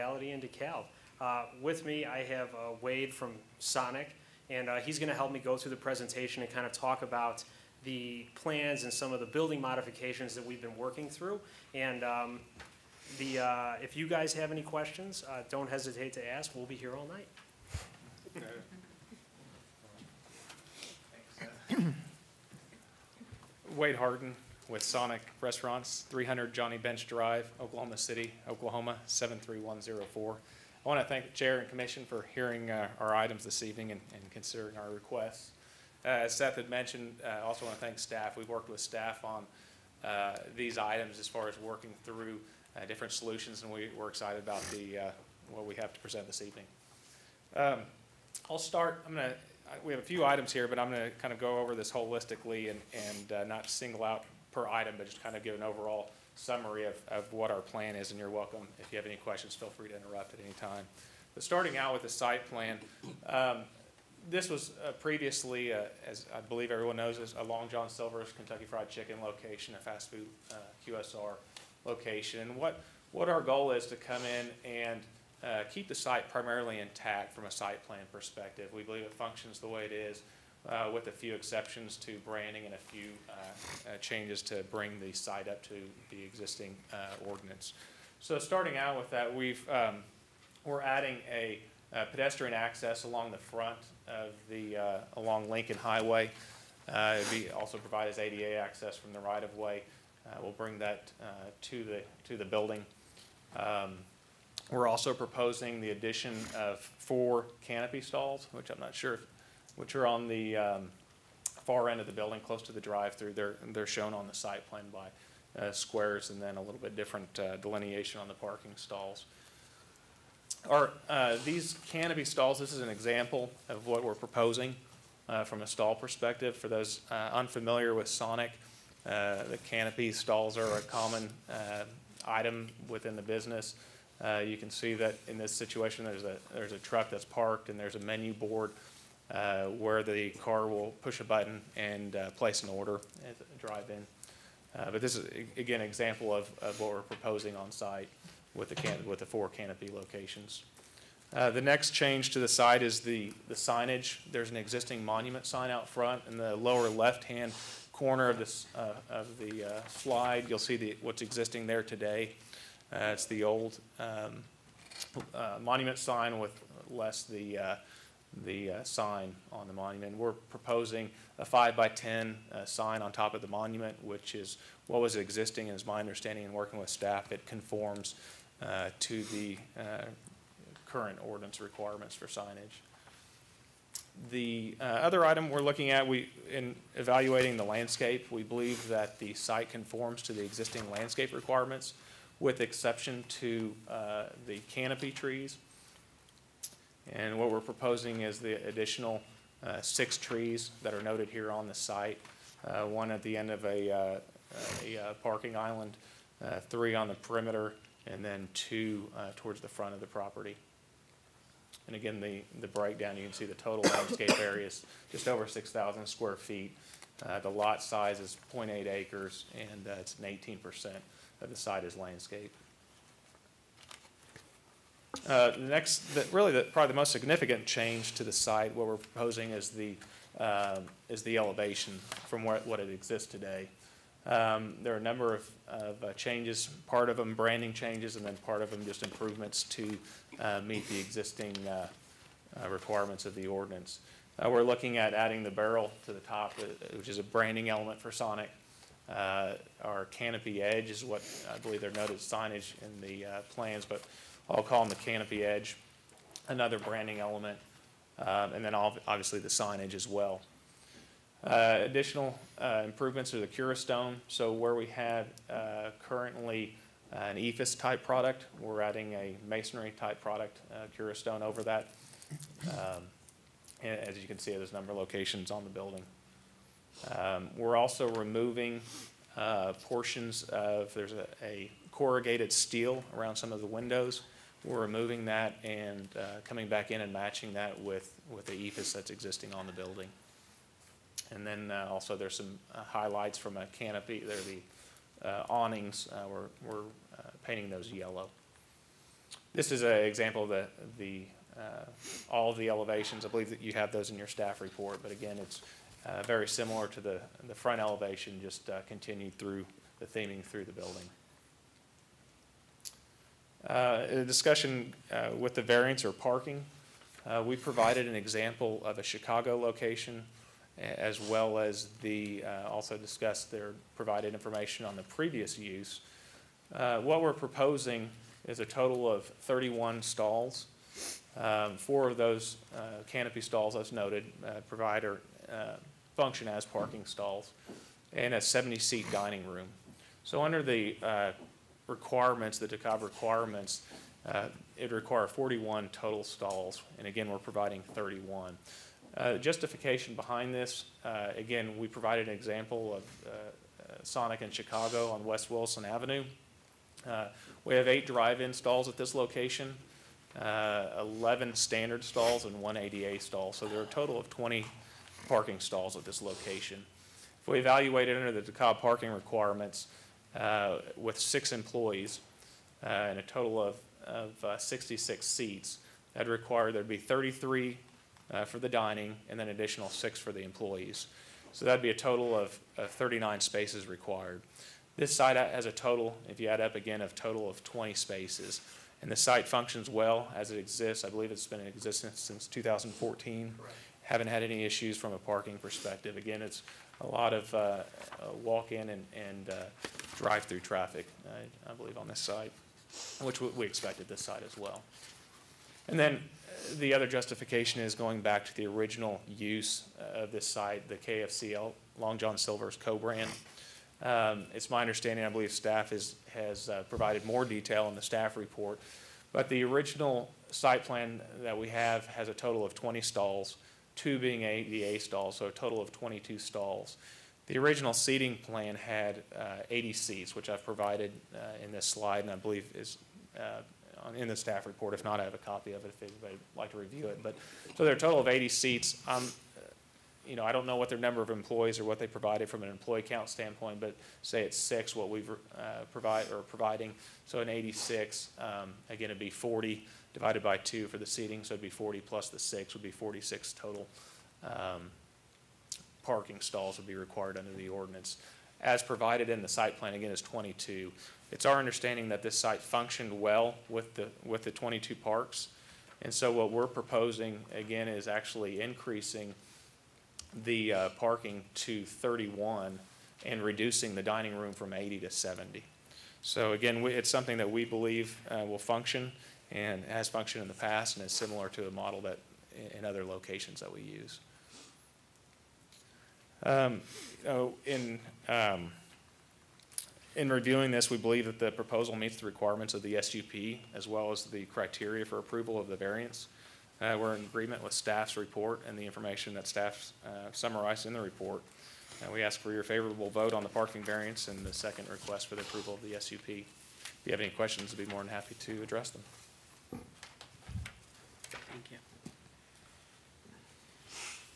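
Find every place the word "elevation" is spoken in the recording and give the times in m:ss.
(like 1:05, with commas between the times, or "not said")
3:51, 5:02, 5:07.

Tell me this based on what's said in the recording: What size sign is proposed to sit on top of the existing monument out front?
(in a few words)
5 by 10.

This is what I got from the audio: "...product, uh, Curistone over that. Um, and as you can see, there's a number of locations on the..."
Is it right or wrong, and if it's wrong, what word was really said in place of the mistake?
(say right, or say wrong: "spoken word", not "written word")
right.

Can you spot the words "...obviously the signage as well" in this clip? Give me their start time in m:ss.
4:18.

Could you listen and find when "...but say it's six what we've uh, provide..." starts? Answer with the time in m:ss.
7:23.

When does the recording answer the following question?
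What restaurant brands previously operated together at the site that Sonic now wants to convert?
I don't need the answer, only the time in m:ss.
1:07.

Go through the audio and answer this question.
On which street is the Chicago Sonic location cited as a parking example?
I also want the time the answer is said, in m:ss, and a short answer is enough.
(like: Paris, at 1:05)
West Wilson Avenue, at 5:55.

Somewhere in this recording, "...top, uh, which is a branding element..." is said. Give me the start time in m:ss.
4:06.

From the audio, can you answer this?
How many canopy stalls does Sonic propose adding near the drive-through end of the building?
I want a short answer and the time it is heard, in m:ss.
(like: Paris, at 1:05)
4, at 1:46.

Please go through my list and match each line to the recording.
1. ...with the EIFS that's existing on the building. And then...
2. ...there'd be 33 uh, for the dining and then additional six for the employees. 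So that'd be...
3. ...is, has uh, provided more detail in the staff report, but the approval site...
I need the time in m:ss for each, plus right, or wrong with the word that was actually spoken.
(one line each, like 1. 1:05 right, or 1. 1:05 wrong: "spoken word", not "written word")
1. 4:48 right
2. 6:16 right
3. 6:55 wrong: "original", not "approval".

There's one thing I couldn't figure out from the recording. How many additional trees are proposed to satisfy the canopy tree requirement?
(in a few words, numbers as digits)
6.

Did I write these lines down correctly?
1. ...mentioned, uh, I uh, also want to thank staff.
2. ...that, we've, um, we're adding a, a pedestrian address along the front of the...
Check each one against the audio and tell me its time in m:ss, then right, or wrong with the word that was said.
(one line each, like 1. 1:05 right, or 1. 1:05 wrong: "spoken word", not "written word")
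1. 0:36 right
2. 1:29 wrong: "access", not "address".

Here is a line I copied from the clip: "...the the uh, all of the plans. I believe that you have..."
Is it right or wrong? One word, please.
wrong.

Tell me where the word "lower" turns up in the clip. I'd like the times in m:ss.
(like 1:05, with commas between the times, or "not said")
2:36.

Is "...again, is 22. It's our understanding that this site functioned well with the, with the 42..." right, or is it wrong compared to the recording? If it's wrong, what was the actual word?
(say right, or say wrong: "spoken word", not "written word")
wrong: "22", not "42".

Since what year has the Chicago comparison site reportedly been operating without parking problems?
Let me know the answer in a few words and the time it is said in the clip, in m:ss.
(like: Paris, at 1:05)
2014, at 6:32.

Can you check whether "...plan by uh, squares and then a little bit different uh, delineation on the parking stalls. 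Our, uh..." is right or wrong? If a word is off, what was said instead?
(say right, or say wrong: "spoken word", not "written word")
right.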